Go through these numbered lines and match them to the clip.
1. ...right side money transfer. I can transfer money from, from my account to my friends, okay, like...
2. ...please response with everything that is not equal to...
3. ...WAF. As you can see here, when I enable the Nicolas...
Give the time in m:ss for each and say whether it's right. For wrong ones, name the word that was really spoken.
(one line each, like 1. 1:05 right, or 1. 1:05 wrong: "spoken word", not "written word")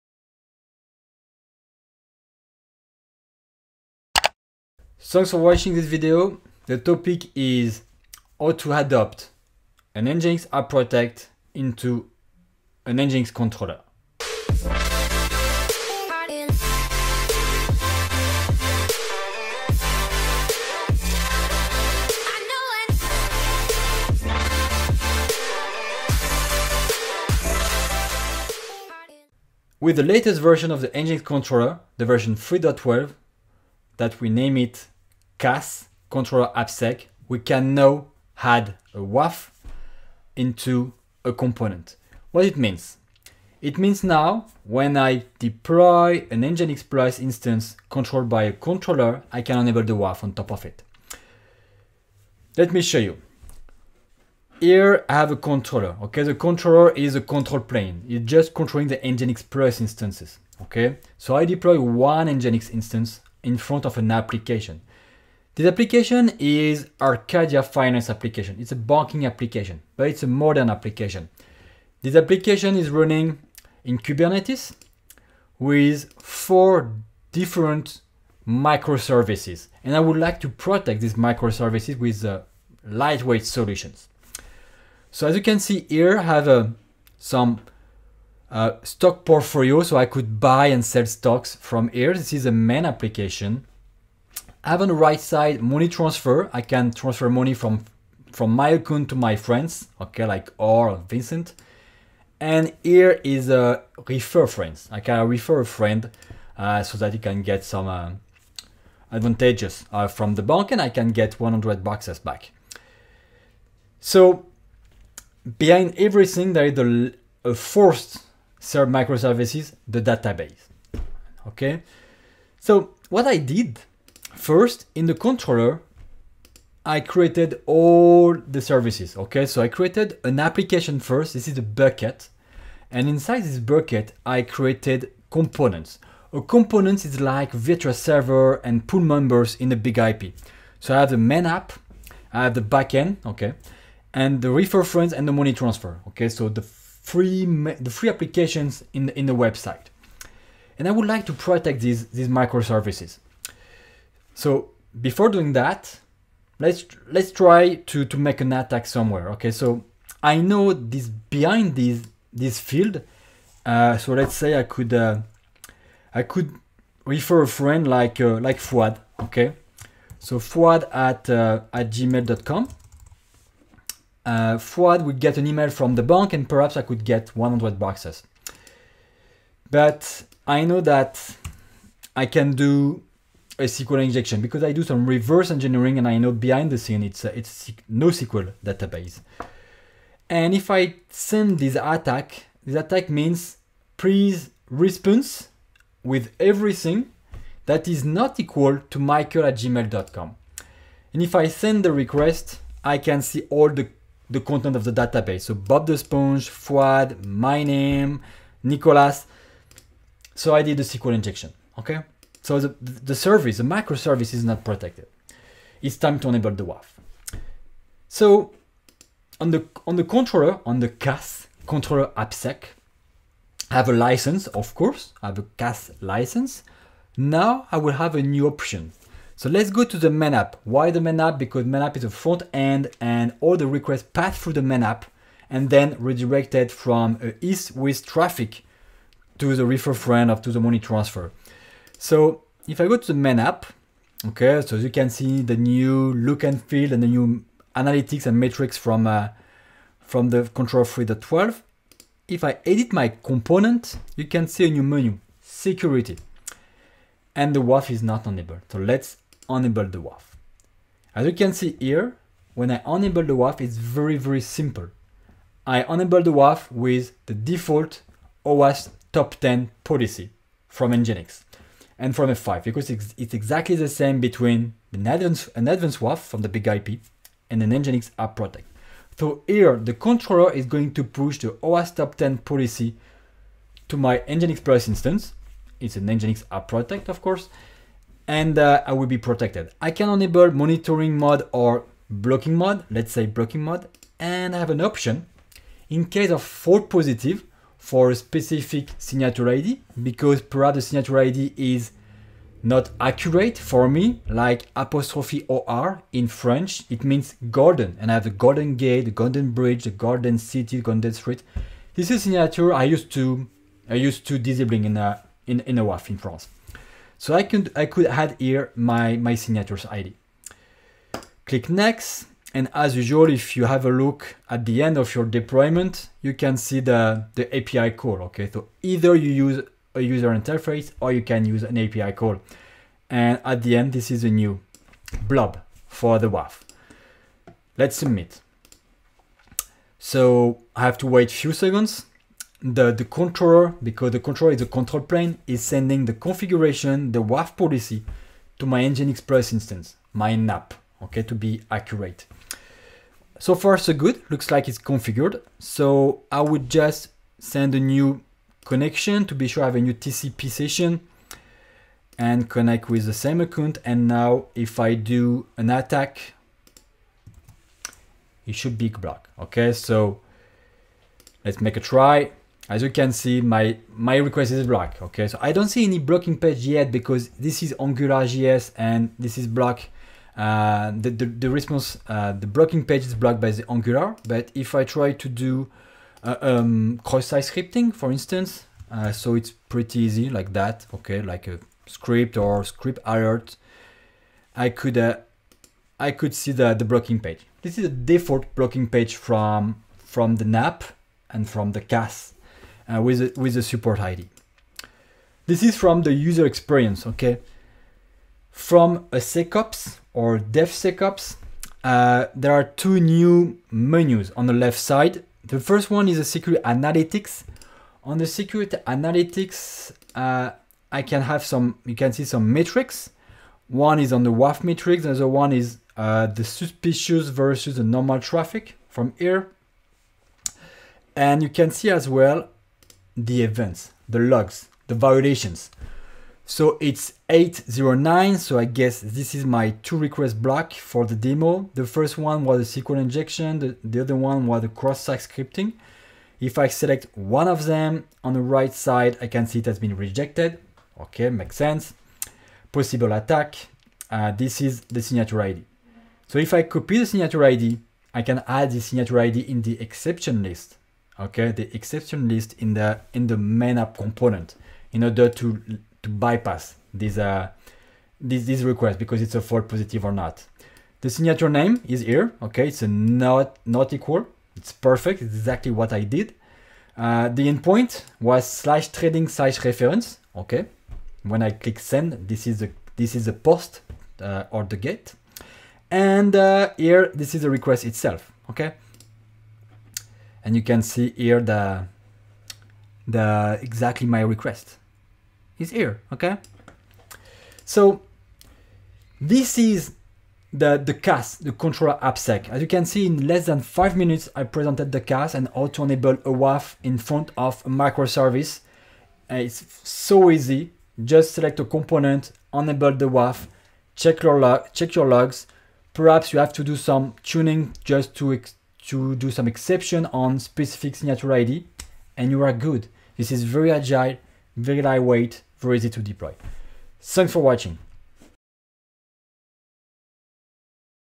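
1. 1:34 right
2. 3:13 right
3. 4:20 wrong: "WAF", not "Nicolas".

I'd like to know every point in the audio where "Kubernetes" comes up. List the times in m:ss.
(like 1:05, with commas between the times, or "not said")
1:13.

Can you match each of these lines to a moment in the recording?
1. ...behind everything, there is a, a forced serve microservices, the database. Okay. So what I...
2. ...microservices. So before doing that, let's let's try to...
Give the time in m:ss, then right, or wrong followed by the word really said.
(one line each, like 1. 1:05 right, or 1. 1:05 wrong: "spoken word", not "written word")
1. 1:55 right
2. 2:32 right.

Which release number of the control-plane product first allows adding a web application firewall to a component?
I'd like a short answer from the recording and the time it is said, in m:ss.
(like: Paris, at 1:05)
3.12, at 0:32.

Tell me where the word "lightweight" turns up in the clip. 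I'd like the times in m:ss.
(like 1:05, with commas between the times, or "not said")
1:22, 8:44.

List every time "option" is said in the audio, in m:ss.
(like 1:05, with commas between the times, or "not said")
3:48, 4:54.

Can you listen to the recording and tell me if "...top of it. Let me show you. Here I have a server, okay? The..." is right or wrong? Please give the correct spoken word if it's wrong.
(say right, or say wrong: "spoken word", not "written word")
wrong: "controller", not "server".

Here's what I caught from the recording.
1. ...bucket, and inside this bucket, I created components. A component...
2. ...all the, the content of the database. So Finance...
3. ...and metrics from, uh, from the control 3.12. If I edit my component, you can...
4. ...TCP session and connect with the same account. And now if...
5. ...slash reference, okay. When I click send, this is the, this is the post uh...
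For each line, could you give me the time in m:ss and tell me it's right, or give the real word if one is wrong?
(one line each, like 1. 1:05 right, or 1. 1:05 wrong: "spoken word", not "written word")
1. 2:11 right
2. 3:23 wrong: "Bob", not "Finance"
3. 4:08 right
4. 5:59 right
5. 7:59 right.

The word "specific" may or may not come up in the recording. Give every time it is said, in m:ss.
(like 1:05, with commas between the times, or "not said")
4:58, 8:40.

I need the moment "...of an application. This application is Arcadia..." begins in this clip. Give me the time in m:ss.
1:03.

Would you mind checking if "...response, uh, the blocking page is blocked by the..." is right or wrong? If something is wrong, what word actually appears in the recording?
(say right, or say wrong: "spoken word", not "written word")
right.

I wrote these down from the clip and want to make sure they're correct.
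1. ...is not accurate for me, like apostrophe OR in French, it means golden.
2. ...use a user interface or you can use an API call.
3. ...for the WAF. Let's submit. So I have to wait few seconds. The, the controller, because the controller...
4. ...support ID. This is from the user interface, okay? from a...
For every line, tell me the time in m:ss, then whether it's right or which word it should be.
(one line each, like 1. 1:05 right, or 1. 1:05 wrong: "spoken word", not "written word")
1. 5:01 right
2. 5:29 right
3. 5:35 right
4. 6:43 wrong: "experience", not "interface".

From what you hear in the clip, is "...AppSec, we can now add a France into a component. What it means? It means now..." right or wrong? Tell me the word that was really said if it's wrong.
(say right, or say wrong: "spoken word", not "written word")
wrong: "WAF", not "France".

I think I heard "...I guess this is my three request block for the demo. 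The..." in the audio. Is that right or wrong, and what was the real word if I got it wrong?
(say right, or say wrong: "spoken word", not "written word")
wrong: "two", not "three".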